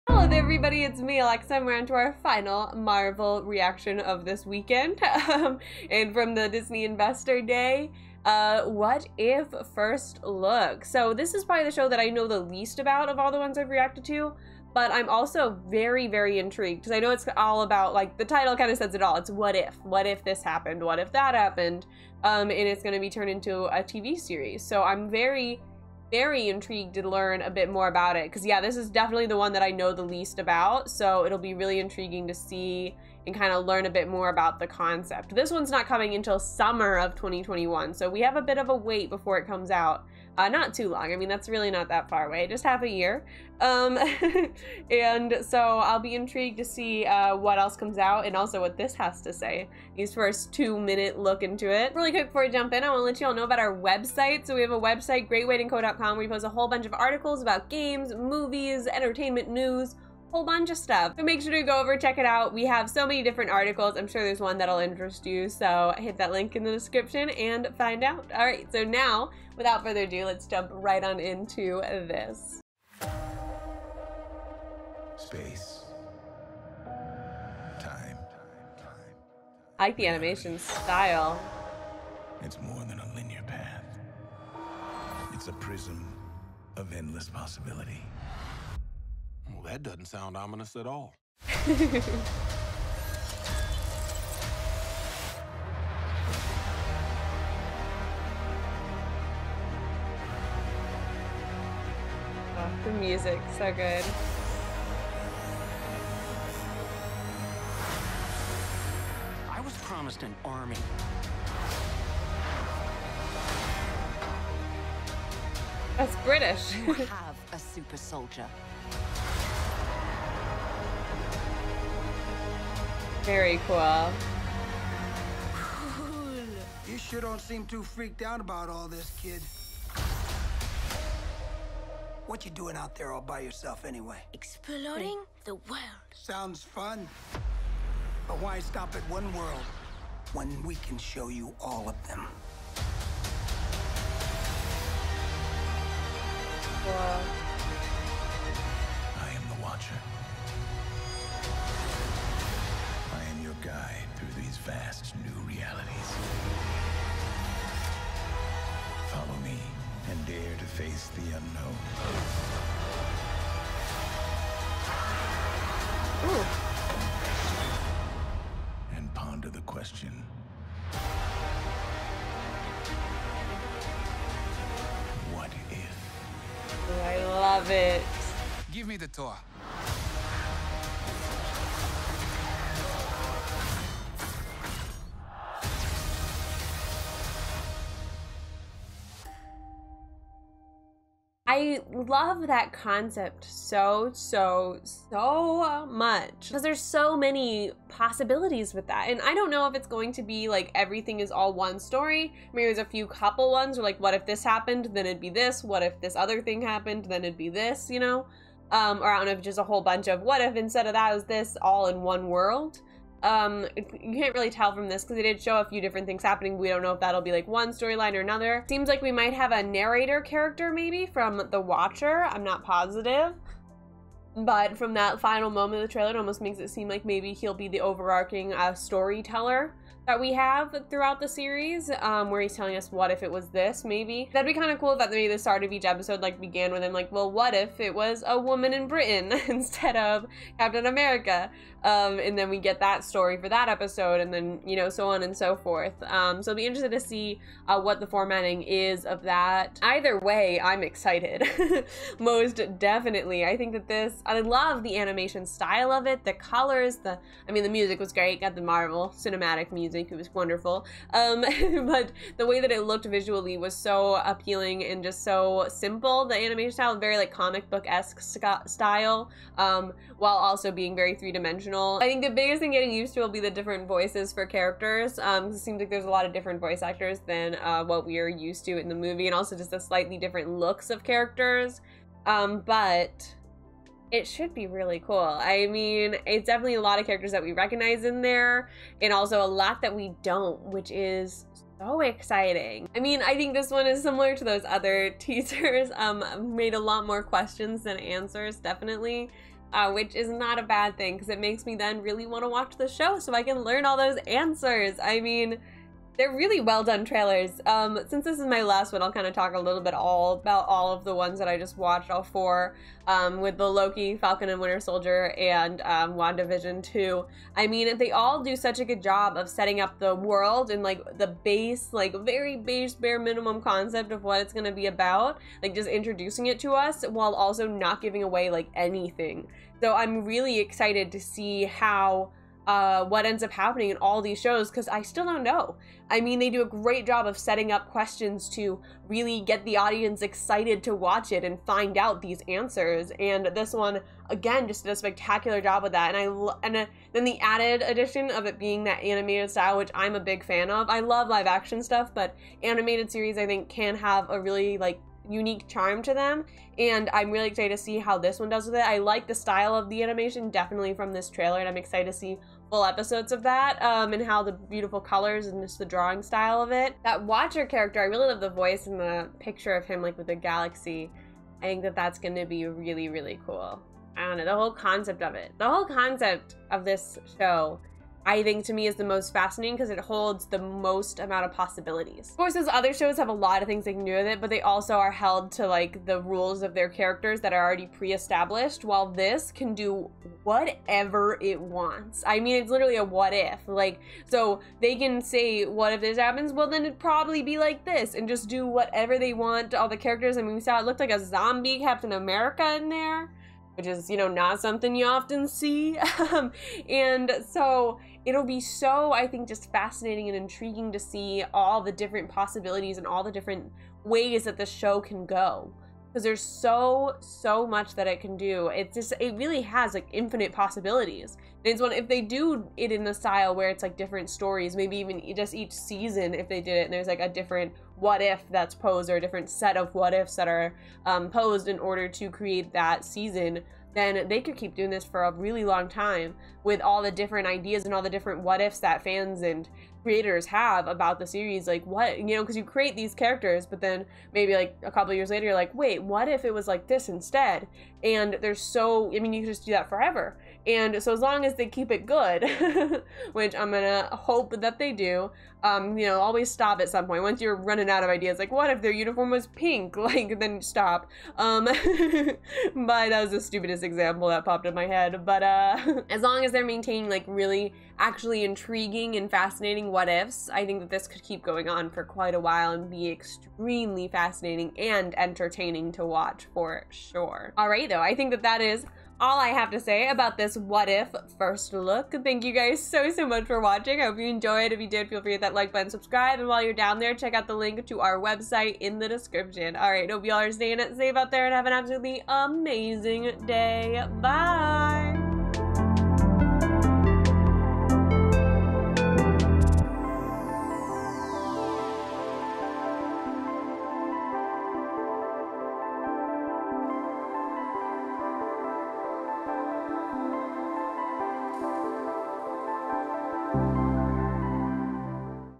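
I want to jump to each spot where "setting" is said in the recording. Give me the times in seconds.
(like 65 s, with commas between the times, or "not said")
319 s, 337 s.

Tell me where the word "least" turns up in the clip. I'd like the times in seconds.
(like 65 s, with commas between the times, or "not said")
12 s, 30 s.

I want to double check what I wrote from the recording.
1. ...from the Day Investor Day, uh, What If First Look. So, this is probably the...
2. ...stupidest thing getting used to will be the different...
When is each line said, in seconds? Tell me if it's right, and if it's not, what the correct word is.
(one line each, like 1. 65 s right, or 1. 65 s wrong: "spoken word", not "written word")
1. 6 s wrong: "Disney", not "Day"
2. 272 s wrong: "biggest", not "stupidest".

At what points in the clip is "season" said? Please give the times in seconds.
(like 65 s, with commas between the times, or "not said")
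425 s, 433 s.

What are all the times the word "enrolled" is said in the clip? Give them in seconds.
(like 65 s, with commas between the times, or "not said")
not said.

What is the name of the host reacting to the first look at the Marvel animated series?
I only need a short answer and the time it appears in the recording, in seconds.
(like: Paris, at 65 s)
Alexa, at 1 s.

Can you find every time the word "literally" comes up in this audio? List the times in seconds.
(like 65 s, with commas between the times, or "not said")
392 s.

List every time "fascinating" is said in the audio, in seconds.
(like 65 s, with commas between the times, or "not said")
379 s, 409 s, 469 s, 474 s.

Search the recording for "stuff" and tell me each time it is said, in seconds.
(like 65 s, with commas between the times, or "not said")
60 s, 351 s.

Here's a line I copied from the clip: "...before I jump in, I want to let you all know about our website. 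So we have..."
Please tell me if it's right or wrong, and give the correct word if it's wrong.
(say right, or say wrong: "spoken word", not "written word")
right.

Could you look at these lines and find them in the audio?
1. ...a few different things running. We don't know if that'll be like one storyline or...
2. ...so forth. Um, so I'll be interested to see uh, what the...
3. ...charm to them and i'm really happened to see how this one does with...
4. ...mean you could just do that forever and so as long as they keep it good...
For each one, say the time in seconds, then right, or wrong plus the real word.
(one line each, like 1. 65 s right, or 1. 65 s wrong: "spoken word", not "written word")
1. 215 s wrong: "happening", not "running"
2. 245 s right
3. 355 s wrong: "excited", not "happened"
4. 449 s right.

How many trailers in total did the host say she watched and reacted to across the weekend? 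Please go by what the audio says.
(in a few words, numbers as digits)
4.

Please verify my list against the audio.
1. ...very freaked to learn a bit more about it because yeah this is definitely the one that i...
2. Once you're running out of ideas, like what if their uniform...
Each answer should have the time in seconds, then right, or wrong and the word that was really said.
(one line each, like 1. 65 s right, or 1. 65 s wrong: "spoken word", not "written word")
1. 26 s wrong: "intrigued", not "freaked"
2. 457 s right.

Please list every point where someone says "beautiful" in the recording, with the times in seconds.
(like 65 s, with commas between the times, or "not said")
364 s.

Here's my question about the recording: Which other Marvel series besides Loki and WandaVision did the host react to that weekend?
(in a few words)
Falcon and Winter Soldier.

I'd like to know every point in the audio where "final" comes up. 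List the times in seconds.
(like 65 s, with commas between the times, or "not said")
2 s, 225 s.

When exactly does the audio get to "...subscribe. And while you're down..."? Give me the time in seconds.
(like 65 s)
485 s.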